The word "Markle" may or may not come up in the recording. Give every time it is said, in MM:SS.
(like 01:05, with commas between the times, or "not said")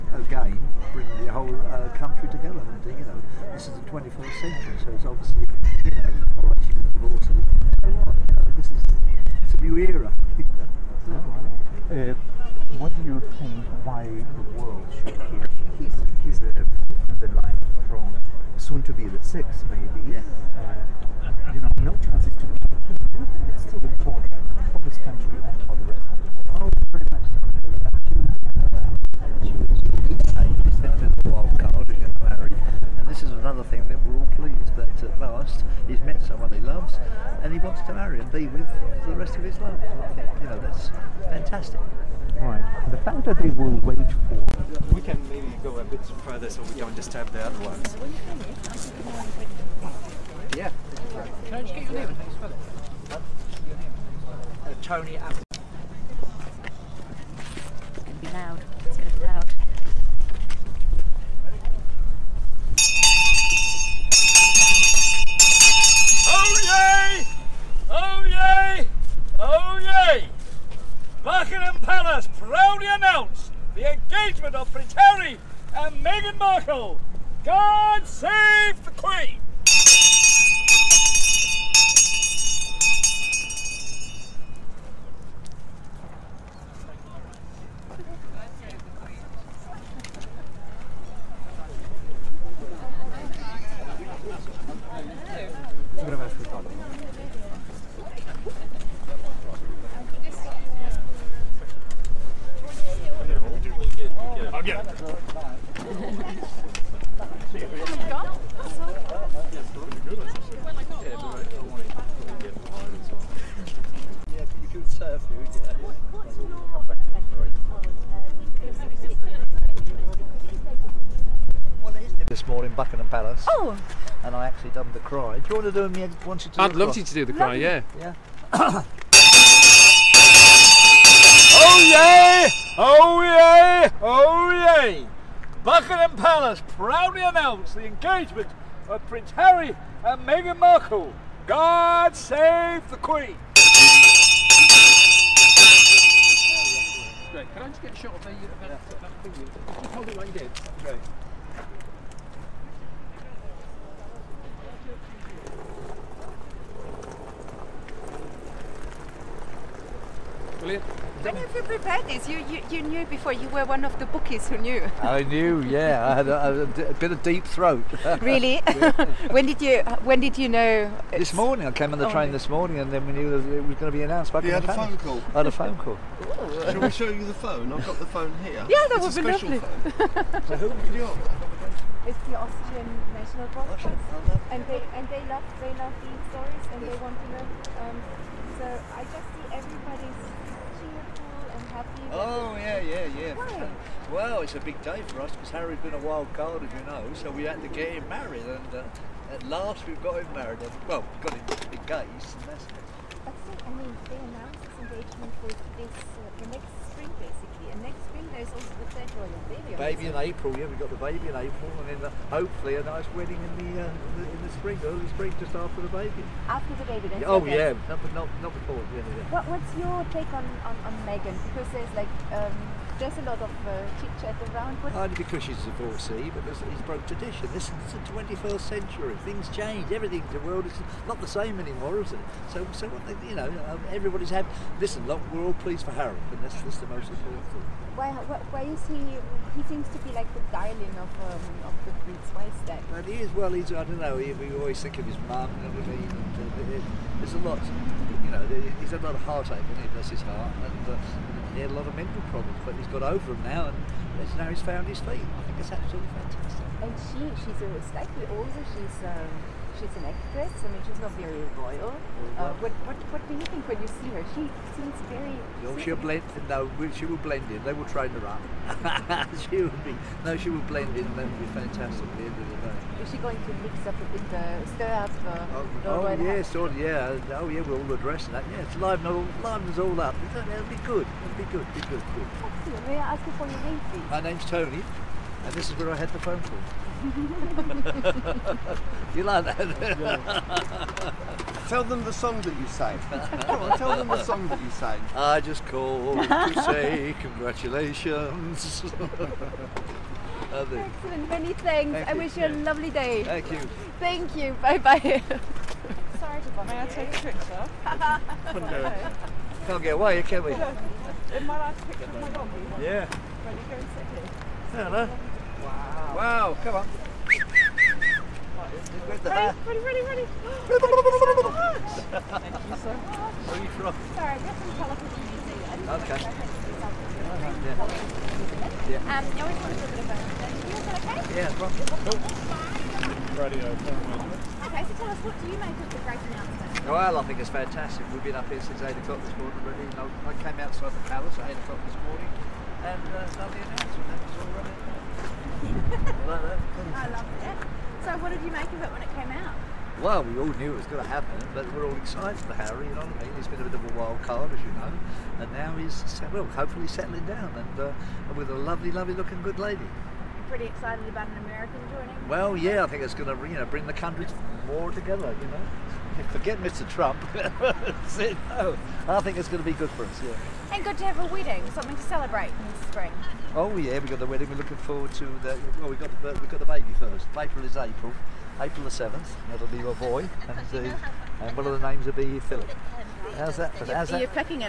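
01:16, 02:20.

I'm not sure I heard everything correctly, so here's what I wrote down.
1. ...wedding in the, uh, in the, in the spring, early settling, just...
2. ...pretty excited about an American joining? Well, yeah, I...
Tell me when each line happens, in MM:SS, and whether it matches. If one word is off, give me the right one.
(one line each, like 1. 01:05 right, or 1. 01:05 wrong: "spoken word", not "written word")
1. 03:33 wrong: "spring", not "settling"
2. 06:00 right.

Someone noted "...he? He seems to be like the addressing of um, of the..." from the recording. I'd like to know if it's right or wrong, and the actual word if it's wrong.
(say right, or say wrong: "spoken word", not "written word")
wrong: "darling", not "addressing".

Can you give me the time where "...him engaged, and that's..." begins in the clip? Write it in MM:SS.
03:21.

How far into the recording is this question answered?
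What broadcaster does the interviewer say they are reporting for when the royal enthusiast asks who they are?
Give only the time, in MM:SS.
03:02.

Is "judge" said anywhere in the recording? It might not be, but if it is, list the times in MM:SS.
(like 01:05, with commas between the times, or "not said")
not said.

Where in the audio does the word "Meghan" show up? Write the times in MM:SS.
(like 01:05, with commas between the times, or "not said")
01:16, 02:20, 03:41.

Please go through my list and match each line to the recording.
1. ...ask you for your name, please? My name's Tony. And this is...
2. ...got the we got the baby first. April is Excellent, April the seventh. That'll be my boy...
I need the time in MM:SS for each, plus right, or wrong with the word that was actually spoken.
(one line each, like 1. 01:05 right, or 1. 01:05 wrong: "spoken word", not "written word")
1. 04:43 right
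2. 06:15 wrong: "April", not "Excellent".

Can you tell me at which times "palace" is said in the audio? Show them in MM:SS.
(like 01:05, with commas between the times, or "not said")
02:16, 05:41.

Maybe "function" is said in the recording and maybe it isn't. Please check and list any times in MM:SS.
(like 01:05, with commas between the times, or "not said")
not said.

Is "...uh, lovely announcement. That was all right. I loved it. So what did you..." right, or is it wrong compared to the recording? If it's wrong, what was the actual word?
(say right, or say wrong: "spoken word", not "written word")
right.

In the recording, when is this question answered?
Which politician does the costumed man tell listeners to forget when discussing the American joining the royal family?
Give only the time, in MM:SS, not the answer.
06:06.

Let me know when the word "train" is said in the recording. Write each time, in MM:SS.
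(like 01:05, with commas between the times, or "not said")
02:52, 04:27.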